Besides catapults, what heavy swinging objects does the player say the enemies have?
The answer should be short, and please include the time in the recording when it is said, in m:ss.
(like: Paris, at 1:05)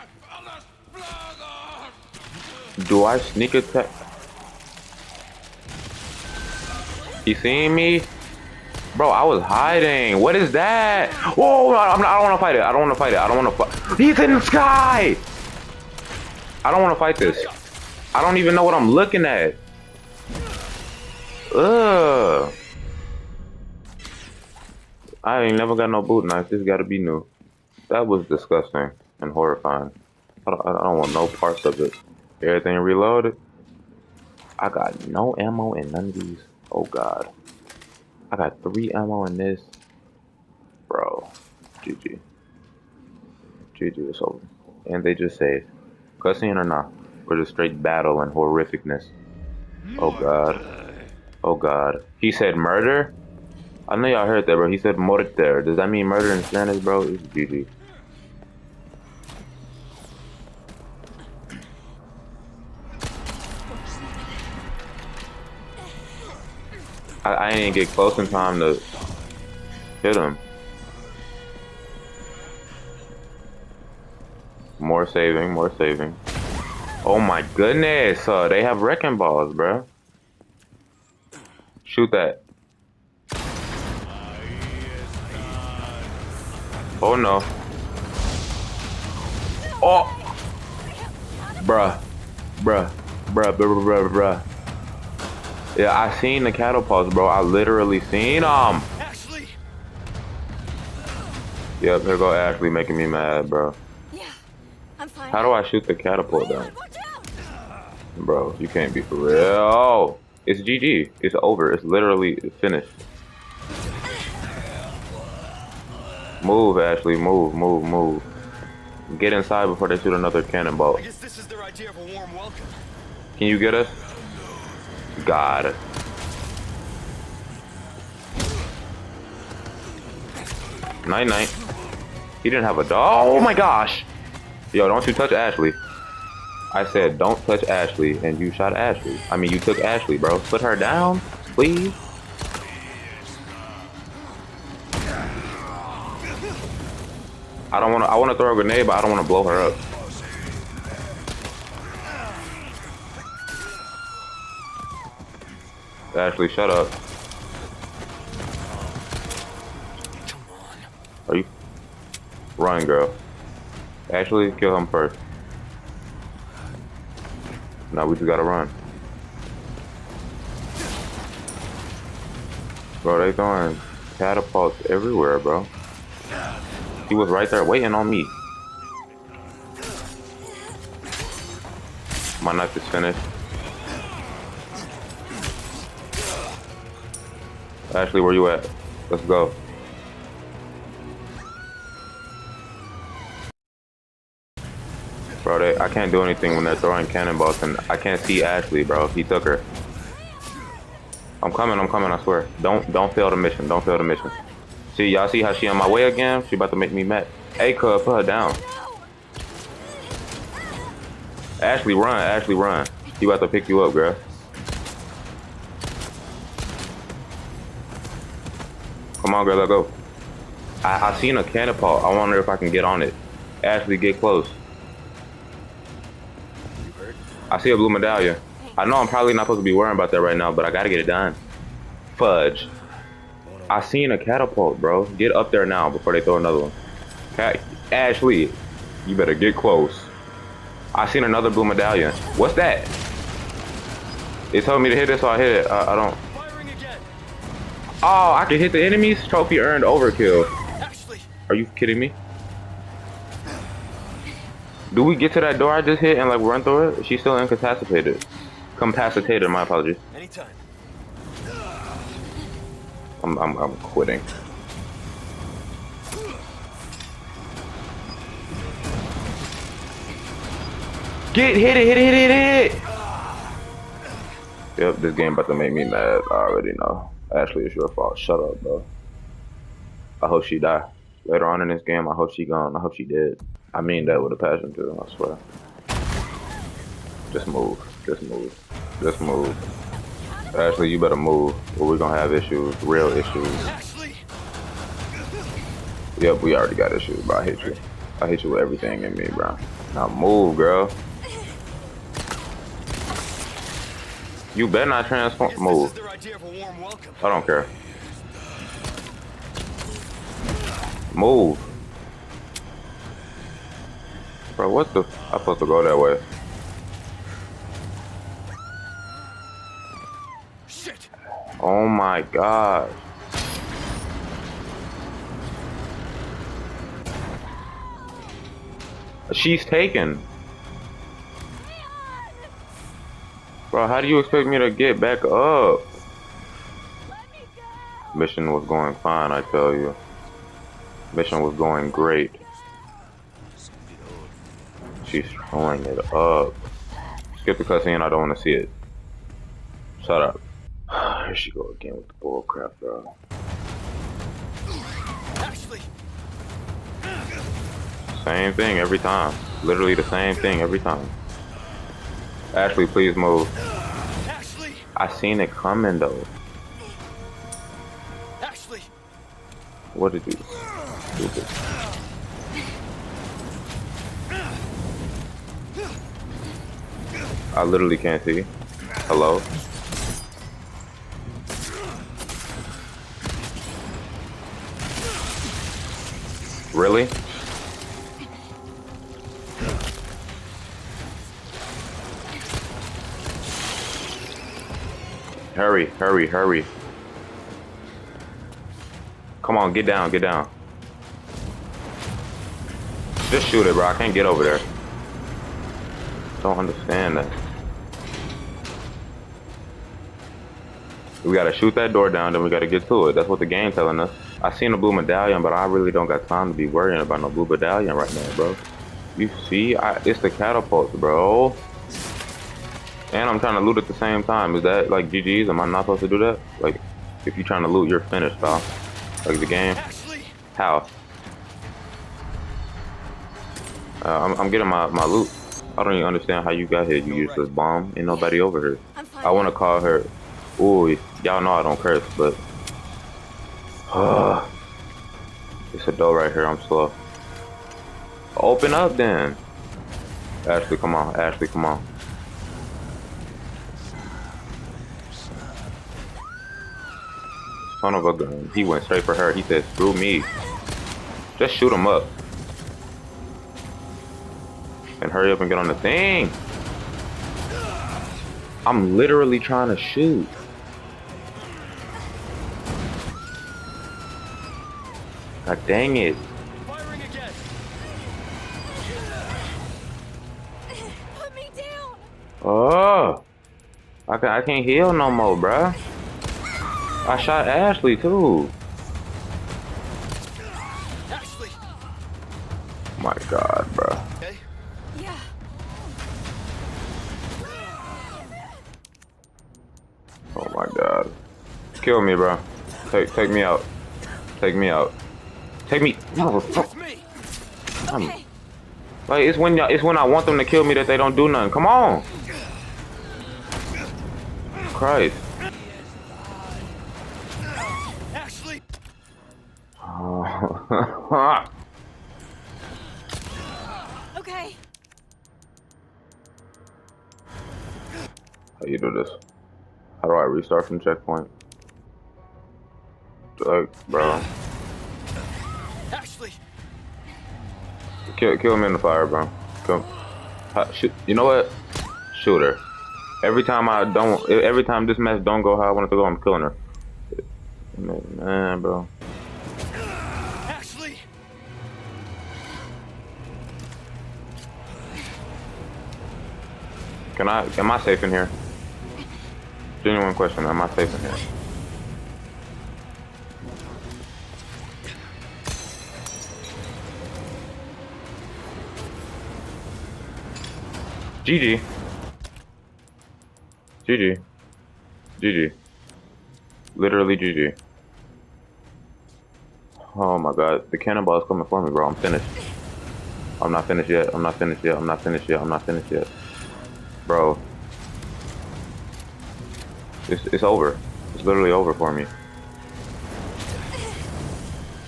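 Wrecking balls, at 1:18.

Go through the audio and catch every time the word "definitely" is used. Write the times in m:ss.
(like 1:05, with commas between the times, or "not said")
not said.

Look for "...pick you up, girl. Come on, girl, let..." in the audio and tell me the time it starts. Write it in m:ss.
3:33.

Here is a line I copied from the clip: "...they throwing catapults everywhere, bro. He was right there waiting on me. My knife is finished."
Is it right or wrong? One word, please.
right.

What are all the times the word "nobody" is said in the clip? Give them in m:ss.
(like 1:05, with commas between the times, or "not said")
7:18.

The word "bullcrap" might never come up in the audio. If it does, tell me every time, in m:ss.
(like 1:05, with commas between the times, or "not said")
5:52.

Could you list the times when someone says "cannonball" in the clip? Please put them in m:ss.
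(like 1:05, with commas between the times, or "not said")
2:00, 3:17, 9:40.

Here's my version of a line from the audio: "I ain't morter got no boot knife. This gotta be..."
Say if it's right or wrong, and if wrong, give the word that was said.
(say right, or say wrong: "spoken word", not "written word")
wrong: "never", not "morter".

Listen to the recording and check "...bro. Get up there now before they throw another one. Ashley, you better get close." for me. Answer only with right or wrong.
right.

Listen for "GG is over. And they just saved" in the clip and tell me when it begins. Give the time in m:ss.
0:43.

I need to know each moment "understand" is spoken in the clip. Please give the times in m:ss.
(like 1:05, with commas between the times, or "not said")
6:46, 7:16.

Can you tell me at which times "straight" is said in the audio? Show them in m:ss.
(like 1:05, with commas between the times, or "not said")
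0:47, 7:38.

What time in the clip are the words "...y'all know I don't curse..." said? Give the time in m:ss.
7:21.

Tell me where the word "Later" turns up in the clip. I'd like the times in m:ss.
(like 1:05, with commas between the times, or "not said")
4:41.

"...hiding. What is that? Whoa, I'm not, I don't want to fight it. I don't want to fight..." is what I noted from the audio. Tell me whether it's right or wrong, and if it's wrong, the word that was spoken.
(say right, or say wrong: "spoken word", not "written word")
right.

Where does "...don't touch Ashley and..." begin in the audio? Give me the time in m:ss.
2:17.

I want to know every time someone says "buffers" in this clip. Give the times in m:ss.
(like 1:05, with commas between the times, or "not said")
not said.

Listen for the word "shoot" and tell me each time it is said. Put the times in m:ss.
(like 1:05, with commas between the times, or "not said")
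1:21, 1:45, 1:59, 6:43, 6:51, 7:41, 7:49, 9:02.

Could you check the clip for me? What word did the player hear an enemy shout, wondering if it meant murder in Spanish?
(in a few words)
Morter.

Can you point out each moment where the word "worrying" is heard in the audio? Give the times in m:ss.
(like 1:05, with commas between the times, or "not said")
3:49, 6:56.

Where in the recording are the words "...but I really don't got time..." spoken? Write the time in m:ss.
6:55.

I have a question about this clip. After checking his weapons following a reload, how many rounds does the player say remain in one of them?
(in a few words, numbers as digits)
3.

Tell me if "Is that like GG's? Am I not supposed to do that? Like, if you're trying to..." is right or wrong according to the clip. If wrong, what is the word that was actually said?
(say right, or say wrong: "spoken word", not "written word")
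right.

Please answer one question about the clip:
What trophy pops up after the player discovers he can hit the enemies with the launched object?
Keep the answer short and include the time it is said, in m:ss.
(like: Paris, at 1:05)
Overkill, at 4:09.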